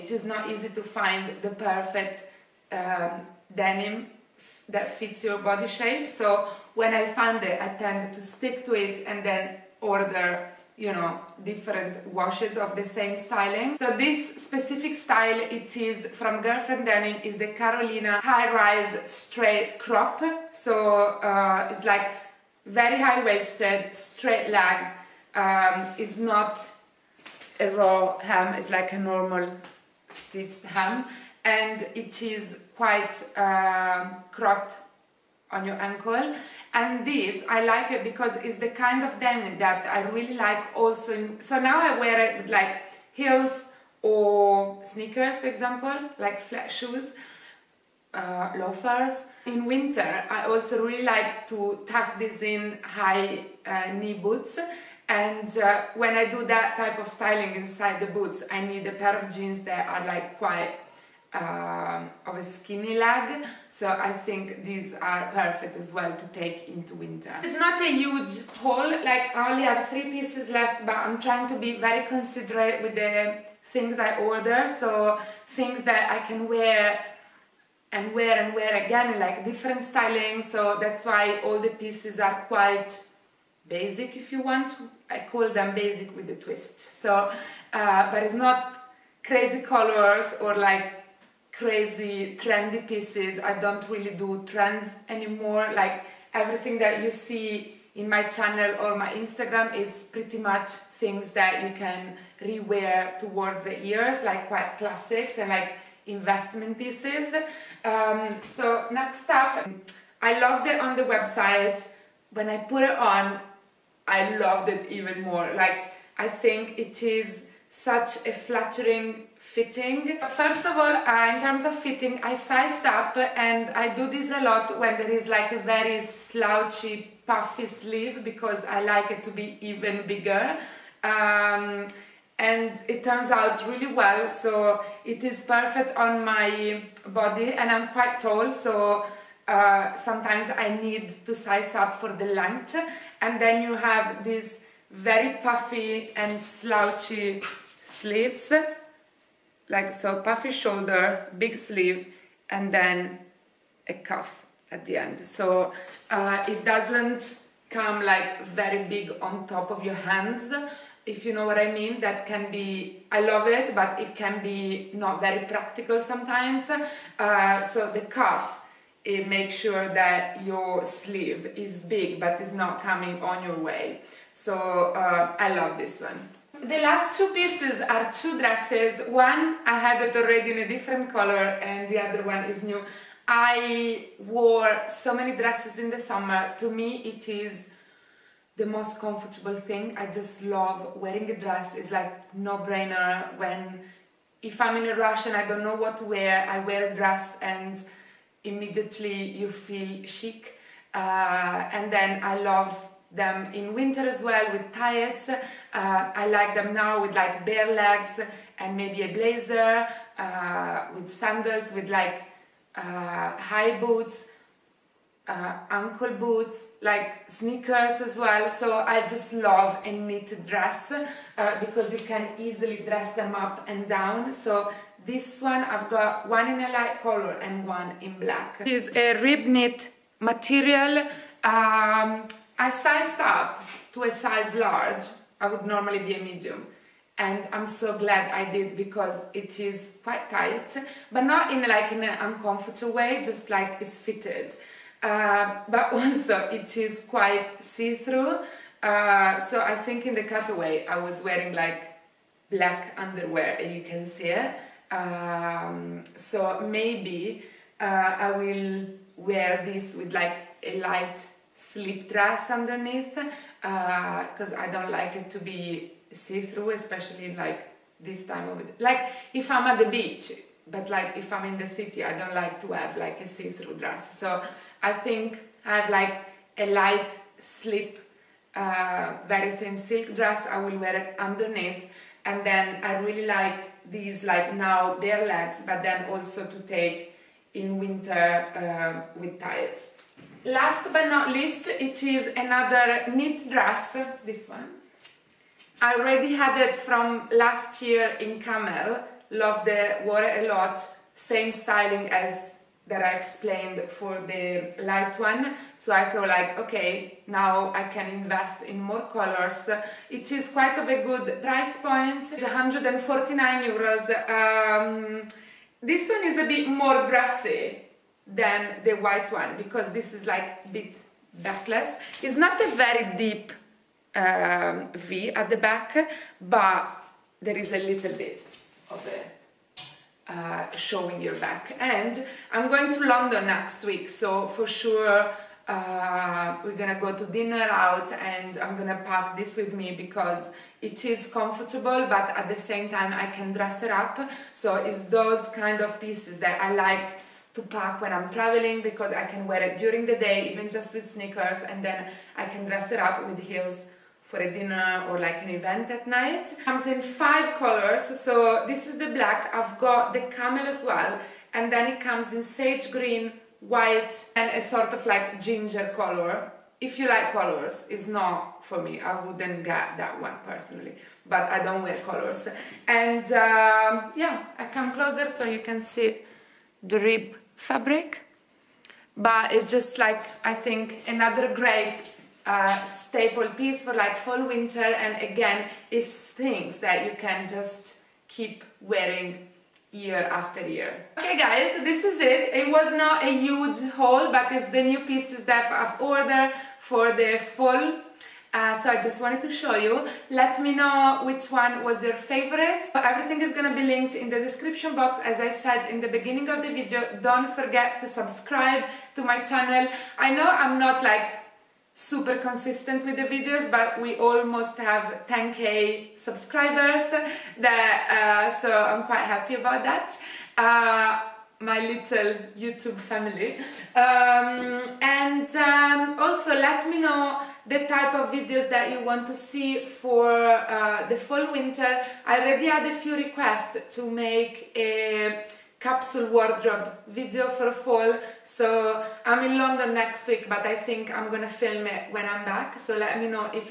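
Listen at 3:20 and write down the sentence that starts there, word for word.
Uh, and then I love them in winter as well with tights.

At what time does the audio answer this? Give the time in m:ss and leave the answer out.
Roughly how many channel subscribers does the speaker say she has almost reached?
6:55.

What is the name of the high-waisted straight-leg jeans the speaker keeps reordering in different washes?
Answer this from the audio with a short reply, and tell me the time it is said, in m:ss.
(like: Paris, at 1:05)
Carolina high rise straight crop, at 0:17.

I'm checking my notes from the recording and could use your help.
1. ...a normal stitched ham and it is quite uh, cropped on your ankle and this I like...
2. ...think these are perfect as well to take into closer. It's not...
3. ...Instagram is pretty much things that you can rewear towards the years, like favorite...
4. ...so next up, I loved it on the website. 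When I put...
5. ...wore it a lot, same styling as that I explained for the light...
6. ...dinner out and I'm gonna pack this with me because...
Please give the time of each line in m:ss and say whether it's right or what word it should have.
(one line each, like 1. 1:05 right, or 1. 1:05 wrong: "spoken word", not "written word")
1. 0:28 right
2. 1:04 wrong: "winter", not "closer"
3. 1:39 wrong: "quite", not "favorite"
4. 1:48 right
5. 5:00 right
6. 5:37 right.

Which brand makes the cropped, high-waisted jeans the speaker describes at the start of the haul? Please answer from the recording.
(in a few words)
Girlfriend Denim.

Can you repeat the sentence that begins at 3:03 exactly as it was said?
I wore so many dresses in the summer.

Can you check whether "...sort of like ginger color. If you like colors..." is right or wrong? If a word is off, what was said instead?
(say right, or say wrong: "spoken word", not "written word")
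right.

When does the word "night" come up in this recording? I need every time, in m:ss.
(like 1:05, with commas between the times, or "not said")
5:56.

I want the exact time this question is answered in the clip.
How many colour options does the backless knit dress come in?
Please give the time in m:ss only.
5:57.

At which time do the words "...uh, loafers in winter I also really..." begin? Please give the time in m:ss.
0:48.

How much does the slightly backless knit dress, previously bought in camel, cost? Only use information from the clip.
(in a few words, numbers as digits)
149 euros.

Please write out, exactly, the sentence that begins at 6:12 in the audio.
And um, yeah, I come closer so you can see the rib fabric.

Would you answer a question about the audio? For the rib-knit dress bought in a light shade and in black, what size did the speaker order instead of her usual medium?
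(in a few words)
Large.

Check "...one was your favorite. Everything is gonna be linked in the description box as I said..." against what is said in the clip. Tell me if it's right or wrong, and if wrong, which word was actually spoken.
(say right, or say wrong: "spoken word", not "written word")
right.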